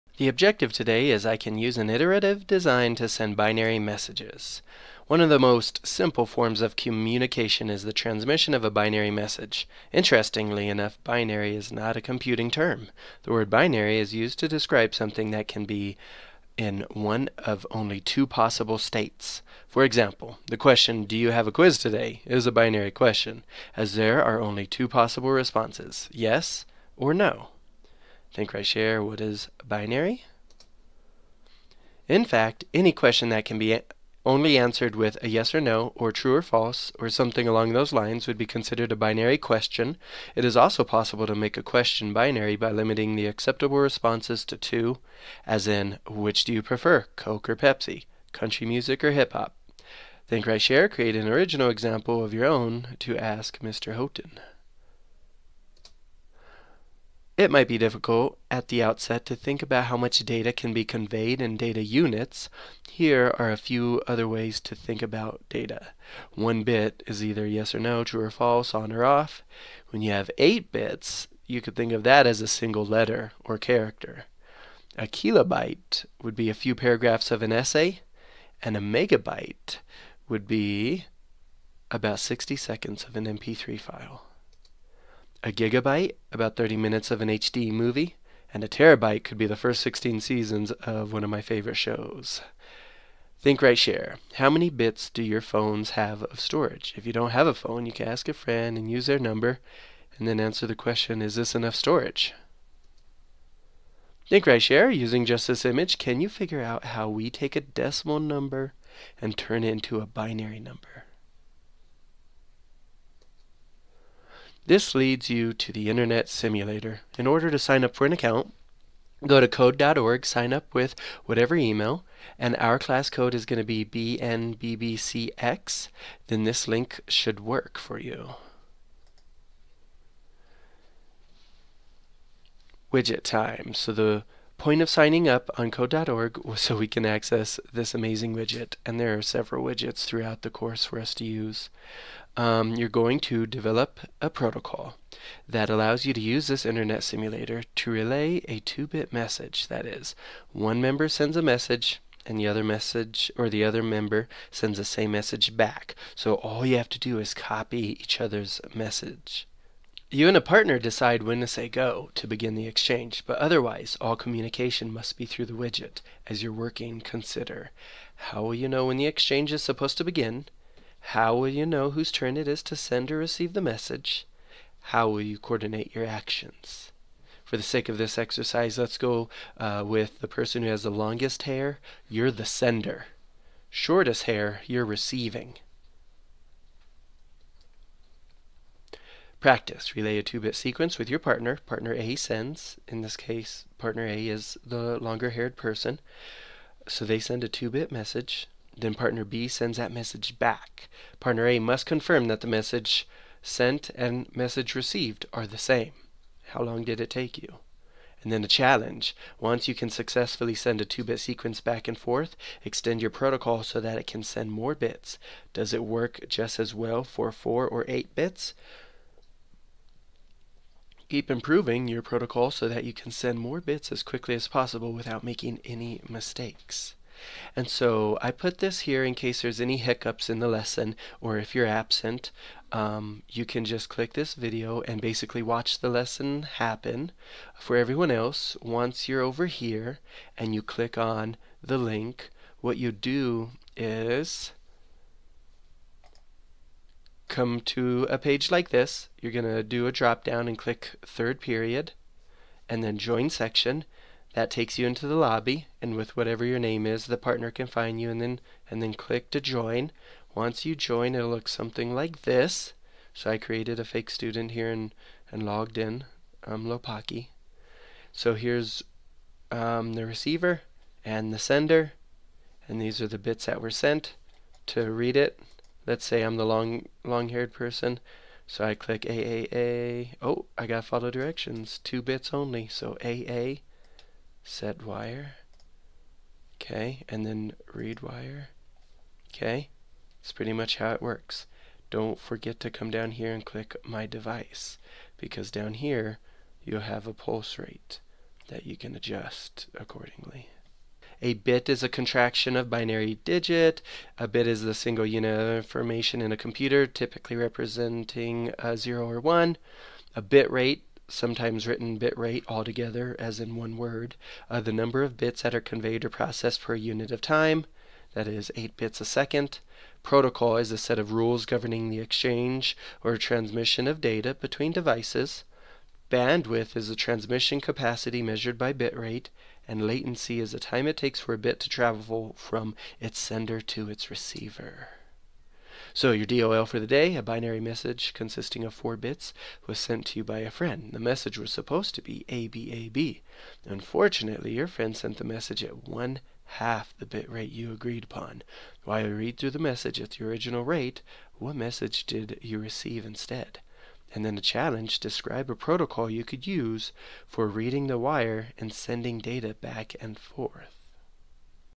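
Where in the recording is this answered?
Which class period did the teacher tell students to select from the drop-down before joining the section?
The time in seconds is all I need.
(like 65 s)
251 s.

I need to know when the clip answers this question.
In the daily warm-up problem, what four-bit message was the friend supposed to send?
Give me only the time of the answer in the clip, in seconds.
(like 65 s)
342 s.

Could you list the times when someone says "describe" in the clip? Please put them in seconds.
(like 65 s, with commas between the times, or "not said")
14 s, 354 s.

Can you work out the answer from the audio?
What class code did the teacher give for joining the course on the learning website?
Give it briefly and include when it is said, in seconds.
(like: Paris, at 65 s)
BNBBCX, at 123 s.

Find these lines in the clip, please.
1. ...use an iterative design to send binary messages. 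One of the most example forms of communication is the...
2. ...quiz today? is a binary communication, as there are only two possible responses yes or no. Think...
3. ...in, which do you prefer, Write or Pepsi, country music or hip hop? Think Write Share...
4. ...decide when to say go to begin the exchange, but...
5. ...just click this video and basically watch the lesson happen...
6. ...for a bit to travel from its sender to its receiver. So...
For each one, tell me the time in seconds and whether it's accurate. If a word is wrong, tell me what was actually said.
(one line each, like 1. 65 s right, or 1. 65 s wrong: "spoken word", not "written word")
1. 1 s wrong: "simple", not "example"
2. 21 s wrong: "question", not "communication"
3. 45 s wrong: "Coke", not "Write"
4. 160 s right
5. 233 s right
6. 331 s right.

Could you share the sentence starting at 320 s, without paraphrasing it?
Protocol is a set of rules governing the exchange or transmission of data between devices.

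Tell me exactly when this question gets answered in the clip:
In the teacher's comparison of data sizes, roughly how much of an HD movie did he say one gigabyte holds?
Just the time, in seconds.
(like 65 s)
86 s.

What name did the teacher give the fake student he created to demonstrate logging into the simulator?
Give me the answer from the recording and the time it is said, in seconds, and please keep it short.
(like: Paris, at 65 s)
Lopaki, at 266 s.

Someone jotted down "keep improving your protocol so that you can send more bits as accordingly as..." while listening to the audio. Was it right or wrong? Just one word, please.
wrong.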